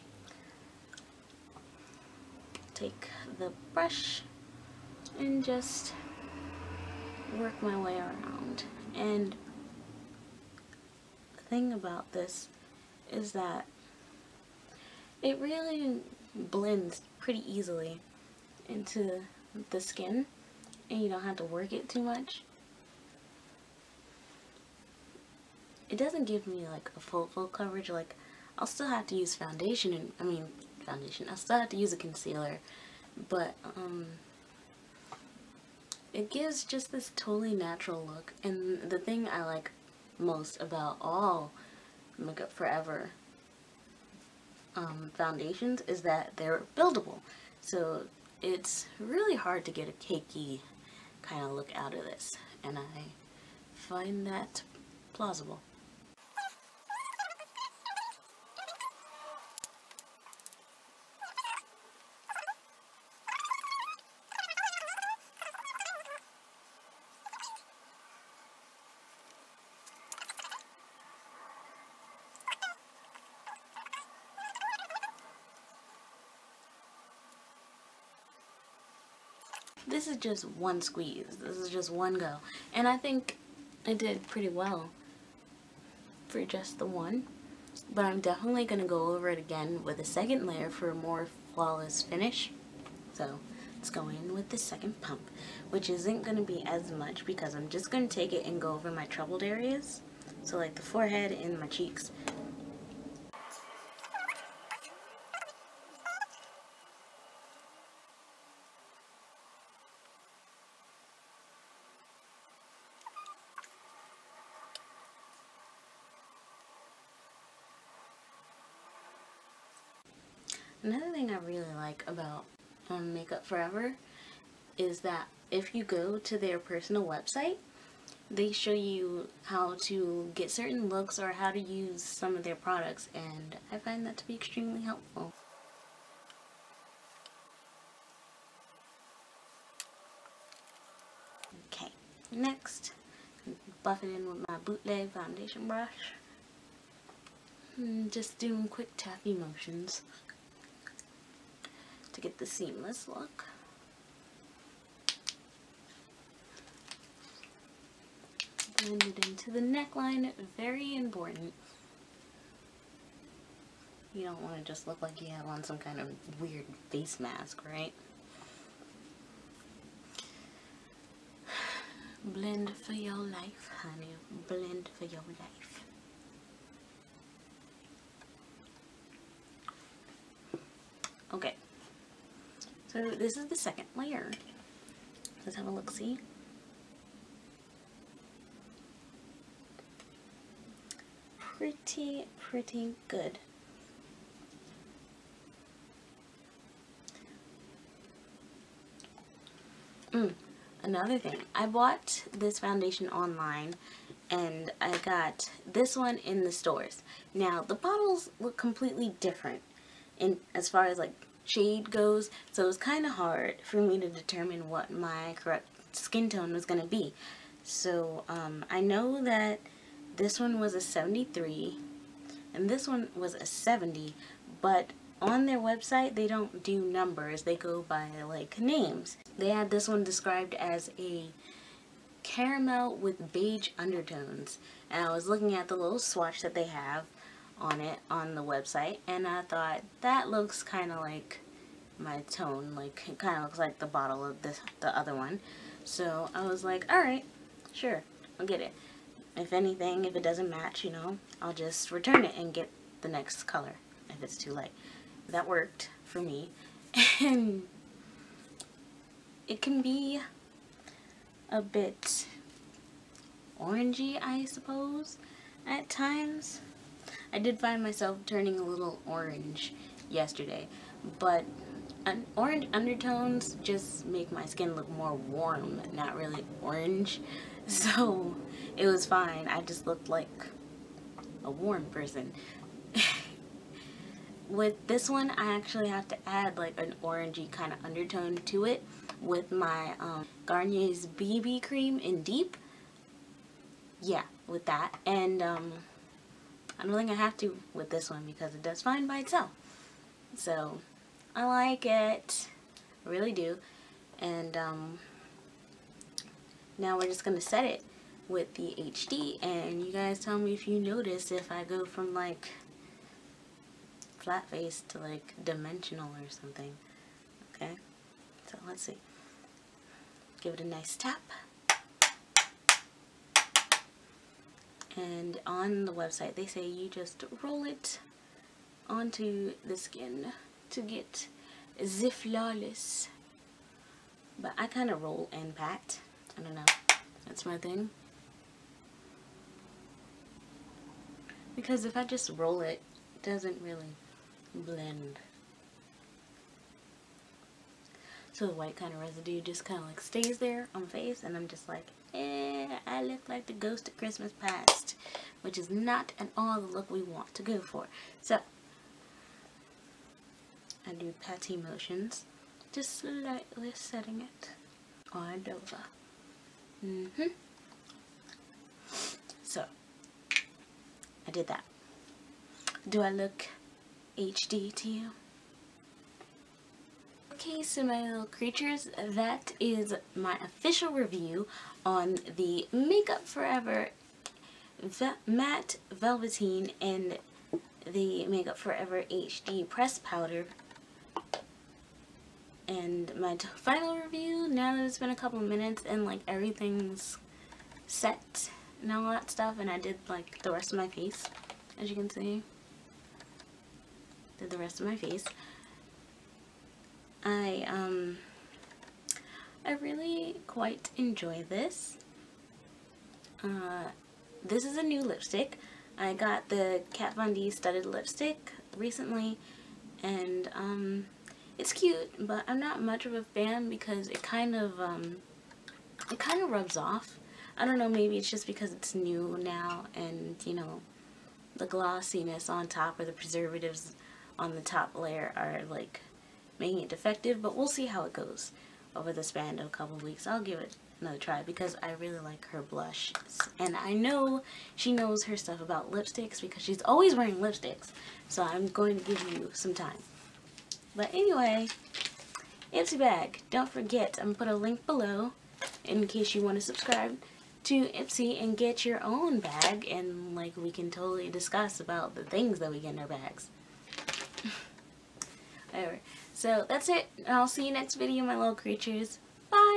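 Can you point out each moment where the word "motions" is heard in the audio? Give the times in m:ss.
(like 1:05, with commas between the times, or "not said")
2:29, 6:01.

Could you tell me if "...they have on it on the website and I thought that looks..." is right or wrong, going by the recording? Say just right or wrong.
right.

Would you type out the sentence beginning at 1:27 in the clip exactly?
But I'm definitely going to go over it again with a second layer for a more flawless finish.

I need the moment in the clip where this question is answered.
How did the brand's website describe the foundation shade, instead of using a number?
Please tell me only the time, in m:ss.
3:52.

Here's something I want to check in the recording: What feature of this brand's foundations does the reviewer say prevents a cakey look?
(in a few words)
buildable.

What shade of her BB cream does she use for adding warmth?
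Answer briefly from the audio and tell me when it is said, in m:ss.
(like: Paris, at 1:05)
Deep, at 4:52.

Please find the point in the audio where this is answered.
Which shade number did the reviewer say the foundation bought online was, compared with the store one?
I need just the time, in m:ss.
3:43.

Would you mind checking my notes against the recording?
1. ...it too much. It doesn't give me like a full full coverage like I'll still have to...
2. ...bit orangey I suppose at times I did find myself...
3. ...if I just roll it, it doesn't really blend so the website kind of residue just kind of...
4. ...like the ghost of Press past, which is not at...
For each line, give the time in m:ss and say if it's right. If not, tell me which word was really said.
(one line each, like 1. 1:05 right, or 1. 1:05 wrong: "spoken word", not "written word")
1. 0:21 right
2. 4:21 right
3. 5:41 wrong: "white", not "website"
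4. 5:53 wrong: "Christmas", not "Press".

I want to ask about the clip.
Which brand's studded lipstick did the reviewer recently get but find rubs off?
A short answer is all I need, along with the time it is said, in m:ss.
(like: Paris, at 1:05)
Kat Von D, at 6:56.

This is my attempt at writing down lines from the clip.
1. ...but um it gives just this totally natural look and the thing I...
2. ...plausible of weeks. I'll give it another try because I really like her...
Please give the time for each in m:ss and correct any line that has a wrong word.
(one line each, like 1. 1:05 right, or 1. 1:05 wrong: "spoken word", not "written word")
1. 0:33 right
2. 7:19 wrong: "couple", not "plausible".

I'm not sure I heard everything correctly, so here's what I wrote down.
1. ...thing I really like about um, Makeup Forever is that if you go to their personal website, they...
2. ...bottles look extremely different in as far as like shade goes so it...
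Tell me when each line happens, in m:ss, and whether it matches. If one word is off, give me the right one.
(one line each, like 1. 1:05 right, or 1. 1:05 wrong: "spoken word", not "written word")
1. 2:01 right
2. 3:27 wrong: "completely", not "extremely".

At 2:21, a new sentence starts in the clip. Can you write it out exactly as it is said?
Okay, next, buff it in with my bootleg foundation brush.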